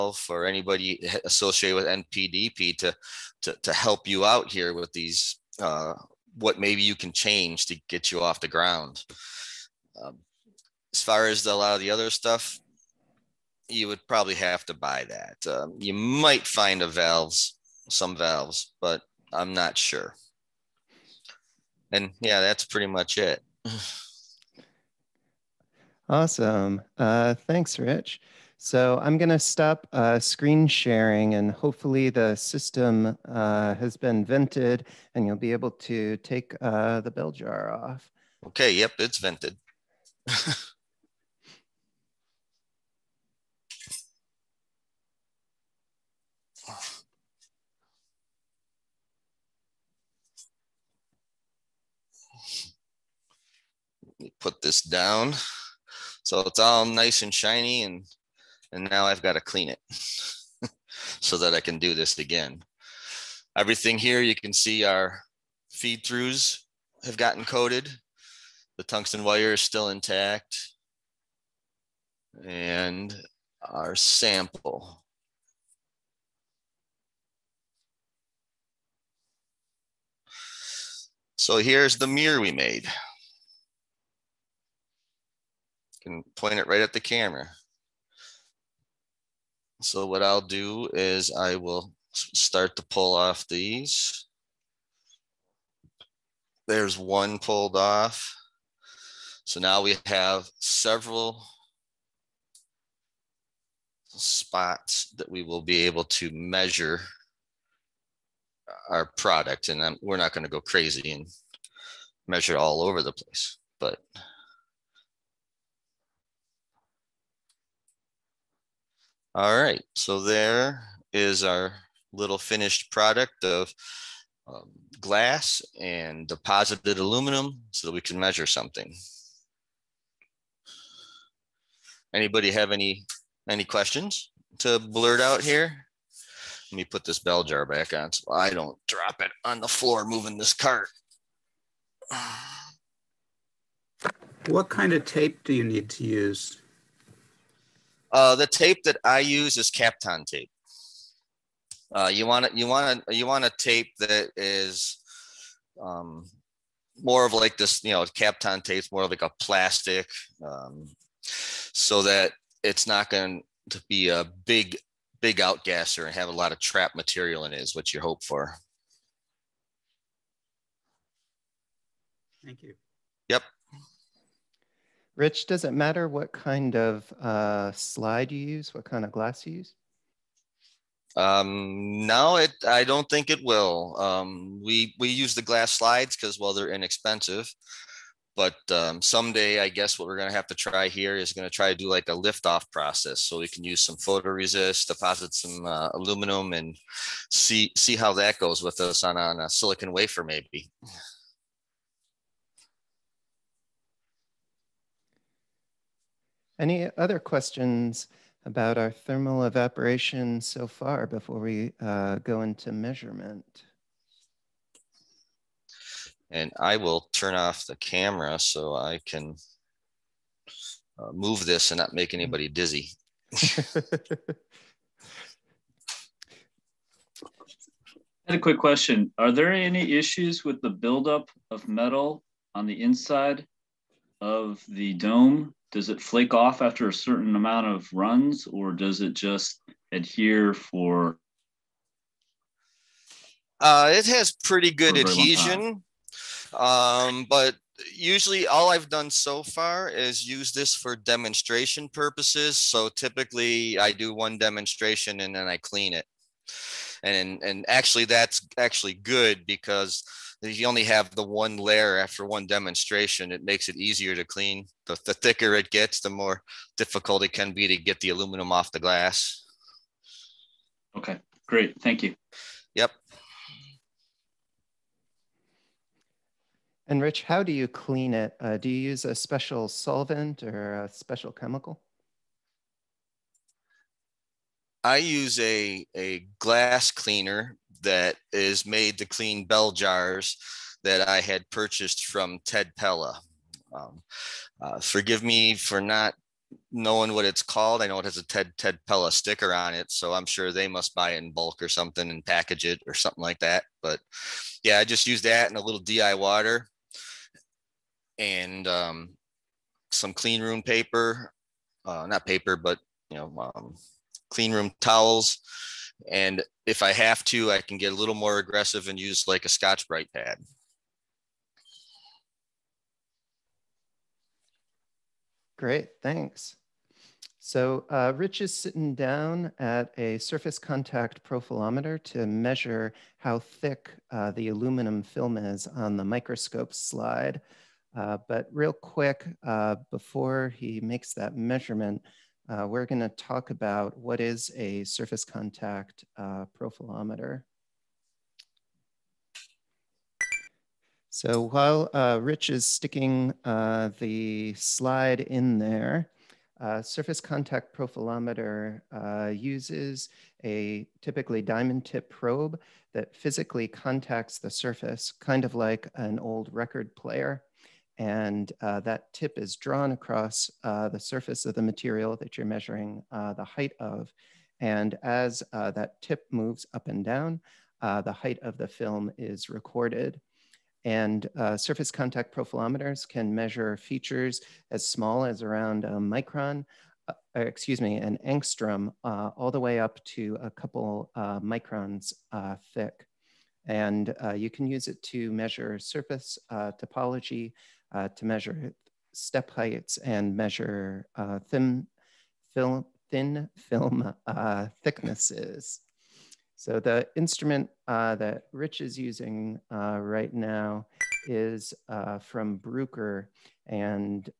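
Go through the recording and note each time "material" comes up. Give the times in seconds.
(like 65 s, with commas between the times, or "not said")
166 s, 371 s.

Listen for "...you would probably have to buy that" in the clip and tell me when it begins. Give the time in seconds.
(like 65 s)
13 s.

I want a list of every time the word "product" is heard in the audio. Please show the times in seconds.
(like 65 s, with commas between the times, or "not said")
109 s, 122 s.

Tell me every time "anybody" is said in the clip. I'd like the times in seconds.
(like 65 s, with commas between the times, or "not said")
0 s, 132 s, 222 s.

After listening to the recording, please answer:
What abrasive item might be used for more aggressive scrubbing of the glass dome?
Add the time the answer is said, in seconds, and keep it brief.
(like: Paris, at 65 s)
Scotch-Brite pad, at 319 s.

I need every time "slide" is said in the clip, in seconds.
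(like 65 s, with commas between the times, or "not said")
177 s, 185 s, 336 s, 354 s.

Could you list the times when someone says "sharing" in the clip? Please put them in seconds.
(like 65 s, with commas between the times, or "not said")
30 s.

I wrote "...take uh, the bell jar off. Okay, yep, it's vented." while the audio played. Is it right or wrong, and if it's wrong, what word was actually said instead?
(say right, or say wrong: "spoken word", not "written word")
right.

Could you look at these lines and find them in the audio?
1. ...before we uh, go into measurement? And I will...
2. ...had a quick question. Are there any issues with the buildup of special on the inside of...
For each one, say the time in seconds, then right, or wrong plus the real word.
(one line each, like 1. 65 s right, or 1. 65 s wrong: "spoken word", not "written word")
1. 211 s right
2. 228 s wrong: "metal", not "special".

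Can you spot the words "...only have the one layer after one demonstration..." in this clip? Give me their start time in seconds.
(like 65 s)
260 s.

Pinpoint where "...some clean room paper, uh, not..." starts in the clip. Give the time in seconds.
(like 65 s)
309 s.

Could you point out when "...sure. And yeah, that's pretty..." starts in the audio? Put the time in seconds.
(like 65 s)
19 s.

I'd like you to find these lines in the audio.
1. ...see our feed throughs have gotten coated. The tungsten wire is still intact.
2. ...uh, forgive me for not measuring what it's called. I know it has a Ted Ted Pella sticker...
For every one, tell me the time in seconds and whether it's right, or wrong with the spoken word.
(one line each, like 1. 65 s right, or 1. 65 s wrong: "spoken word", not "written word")
1. 64 s right
2. 294 s wrong: "knowing", not "measuring".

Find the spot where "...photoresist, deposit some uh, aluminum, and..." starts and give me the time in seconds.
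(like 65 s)
193 s.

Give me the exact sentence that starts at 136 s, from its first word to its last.
Let me put this bell jar back on so I don't drop it on the floor moving this cart.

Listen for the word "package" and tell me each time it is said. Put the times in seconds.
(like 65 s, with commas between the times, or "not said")
302 s.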